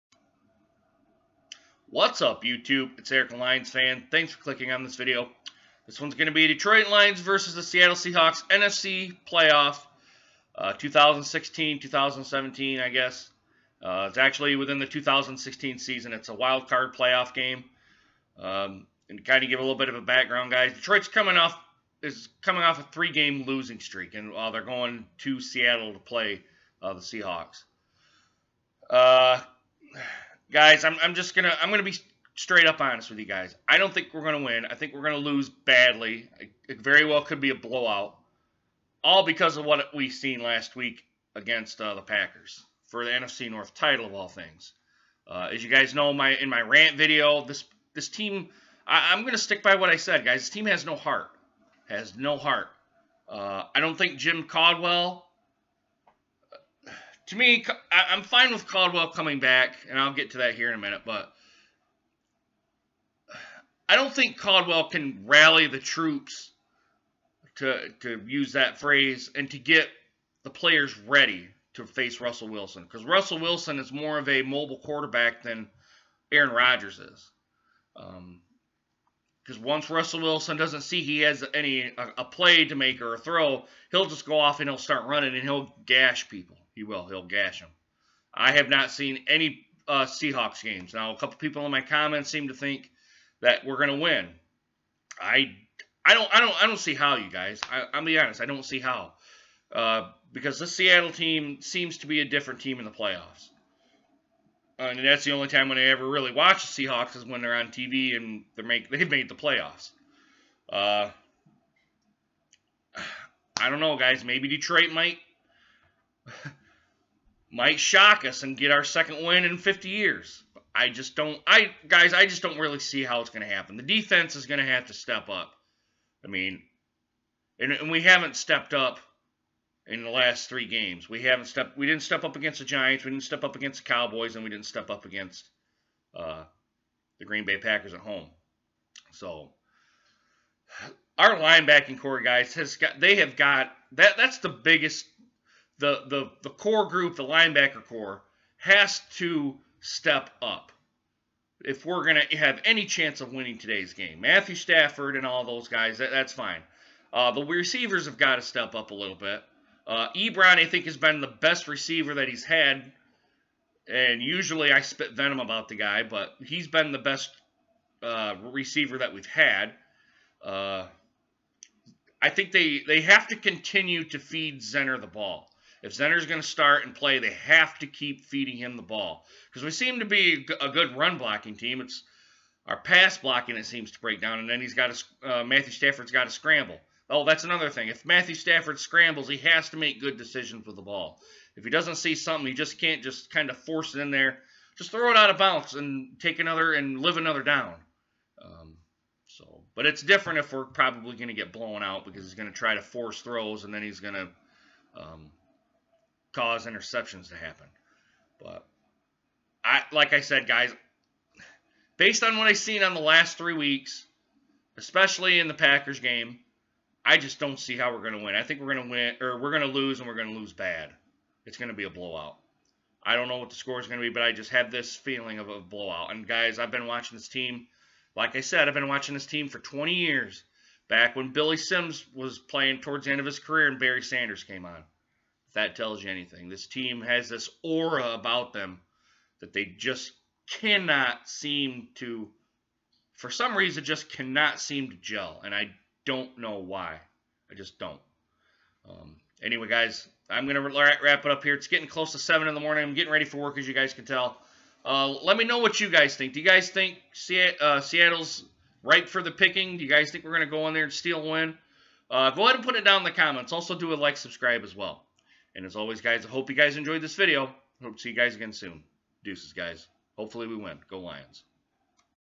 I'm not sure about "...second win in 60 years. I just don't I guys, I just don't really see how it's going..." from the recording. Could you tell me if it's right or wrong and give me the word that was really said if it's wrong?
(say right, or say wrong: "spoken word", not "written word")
wrong: "50", not "60".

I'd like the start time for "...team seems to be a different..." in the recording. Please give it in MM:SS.
01:41.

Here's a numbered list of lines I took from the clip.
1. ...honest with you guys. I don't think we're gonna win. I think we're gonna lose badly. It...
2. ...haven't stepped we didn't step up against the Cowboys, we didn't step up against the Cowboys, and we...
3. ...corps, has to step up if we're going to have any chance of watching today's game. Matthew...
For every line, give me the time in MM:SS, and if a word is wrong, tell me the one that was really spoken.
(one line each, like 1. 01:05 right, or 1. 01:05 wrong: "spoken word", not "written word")
1. 00:32 right
2. 02:11 wrong: "Giants", not "Cowboys"
3. 02:27 wrong: "winning", not "watching".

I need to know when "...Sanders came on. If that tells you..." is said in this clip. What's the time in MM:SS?
03:54.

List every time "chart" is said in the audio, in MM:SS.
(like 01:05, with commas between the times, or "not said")
not said.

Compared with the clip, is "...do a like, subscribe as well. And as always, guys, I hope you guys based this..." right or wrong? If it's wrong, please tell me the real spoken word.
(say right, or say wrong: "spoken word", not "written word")
wrong: "enjoyed", not "based".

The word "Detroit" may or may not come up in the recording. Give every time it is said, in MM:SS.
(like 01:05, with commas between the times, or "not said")
00:06, 00:20, 01:54.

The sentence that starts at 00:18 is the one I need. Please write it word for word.
Um, and kind of give a little bit of a background, guys.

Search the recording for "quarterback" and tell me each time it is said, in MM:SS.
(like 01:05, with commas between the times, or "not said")
01:14.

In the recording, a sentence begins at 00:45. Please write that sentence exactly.
Uh, as you guys know, my in my rant video, this this team, I, am gonna stick by what I said, guys.